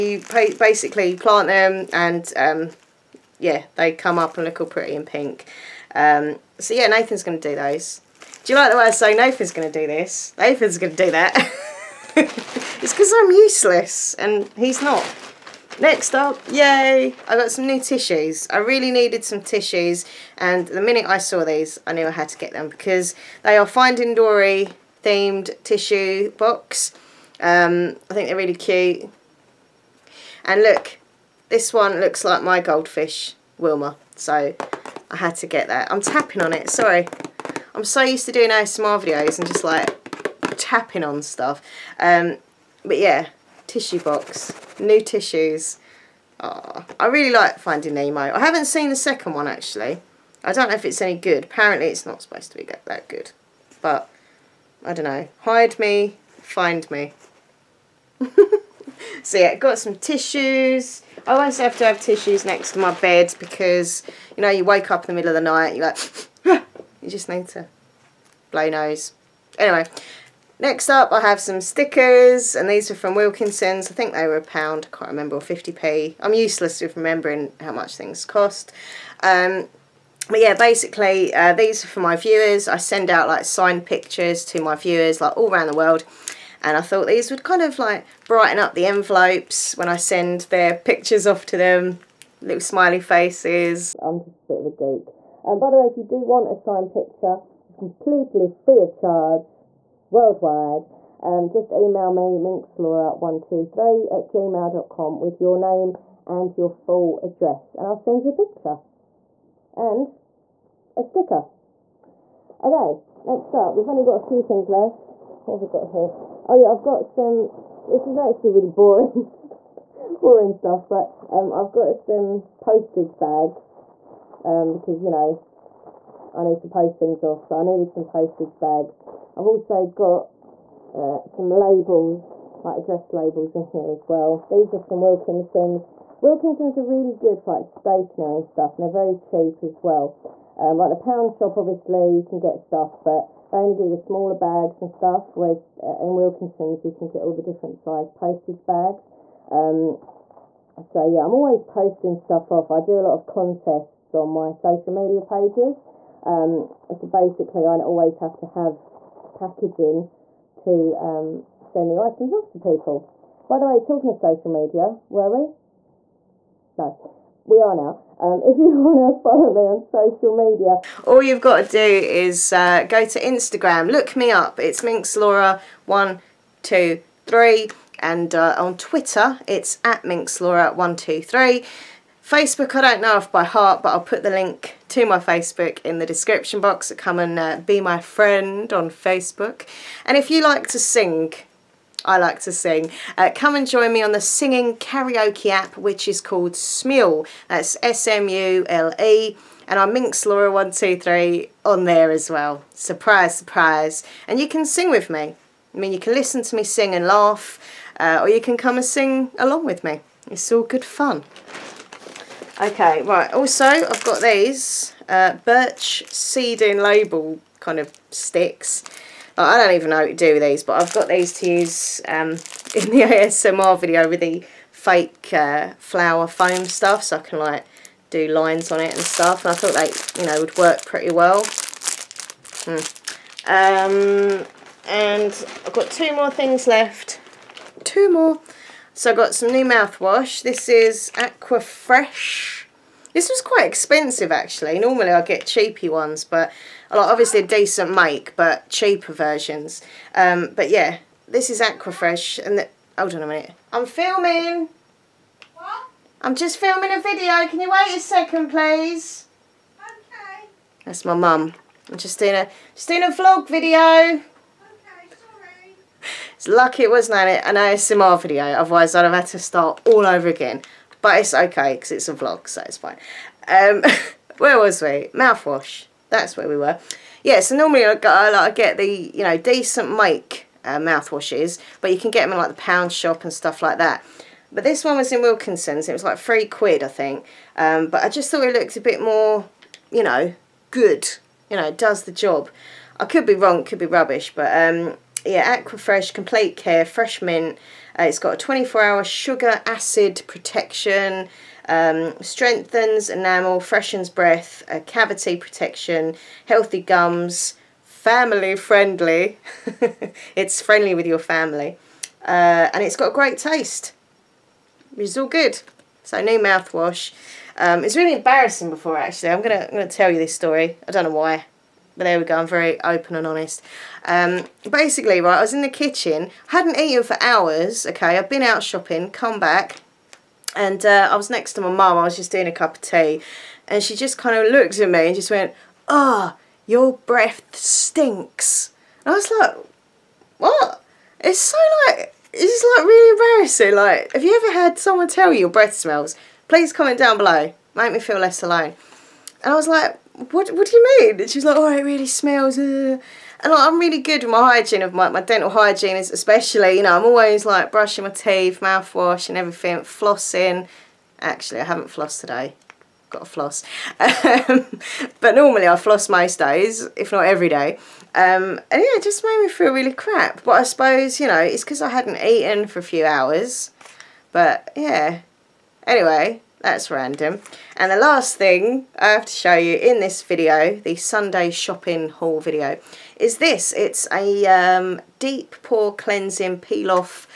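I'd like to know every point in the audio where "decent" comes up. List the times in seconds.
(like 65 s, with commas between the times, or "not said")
247 s, 279 s.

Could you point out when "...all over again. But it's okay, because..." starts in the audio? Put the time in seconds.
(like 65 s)
269 s.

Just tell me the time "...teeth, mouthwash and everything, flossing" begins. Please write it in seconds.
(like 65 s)
358 s.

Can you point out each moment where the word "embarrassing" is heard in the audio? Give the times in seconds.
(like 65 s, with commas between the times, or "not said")
318 s, 343 s.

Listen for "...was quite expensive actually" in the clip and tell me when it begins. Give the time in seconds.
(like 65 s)
243 s.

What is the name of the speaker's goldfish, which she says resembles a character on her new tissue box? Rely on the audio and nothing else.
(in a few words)
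Wilma.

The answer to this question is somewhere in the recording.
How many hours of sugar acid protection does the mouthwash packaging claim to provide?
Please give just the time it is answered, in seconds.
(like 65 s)
298 s.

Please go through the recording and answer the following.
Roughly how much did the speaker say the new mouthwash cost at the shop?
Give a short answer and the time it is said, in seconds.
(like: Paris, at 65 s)
three quid, at 286 s.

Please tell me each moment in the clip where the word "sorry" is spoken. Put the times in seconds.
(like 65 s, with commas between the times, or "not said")
36 s.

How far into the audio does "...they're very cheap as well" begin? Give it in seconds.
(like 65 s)
138 s.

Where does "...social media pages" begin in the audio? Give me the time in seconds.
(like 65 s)
154 s.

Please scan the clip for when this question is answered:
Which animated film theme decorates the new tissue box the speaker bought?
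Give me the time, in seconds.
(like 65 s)
23 s.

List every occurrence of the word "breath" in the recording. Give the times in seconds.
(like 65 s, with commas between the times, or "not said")
304 s, 337 s, 345 s.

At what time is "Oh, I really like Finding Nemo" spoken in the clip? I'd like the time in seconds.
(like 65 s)
46 s.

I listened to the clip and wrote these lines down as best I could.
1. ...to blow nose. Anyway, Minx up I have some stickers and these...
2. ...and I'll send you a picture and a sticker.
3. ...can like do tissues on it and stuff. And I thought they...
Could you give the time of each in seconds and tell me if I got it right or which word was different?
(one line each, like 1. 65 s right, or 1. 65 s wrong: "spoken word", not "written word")
1. 67 s wrong: "Next", not "Minx"
2. 107 s right
3. 227 s wrong: "lines", not "tissues".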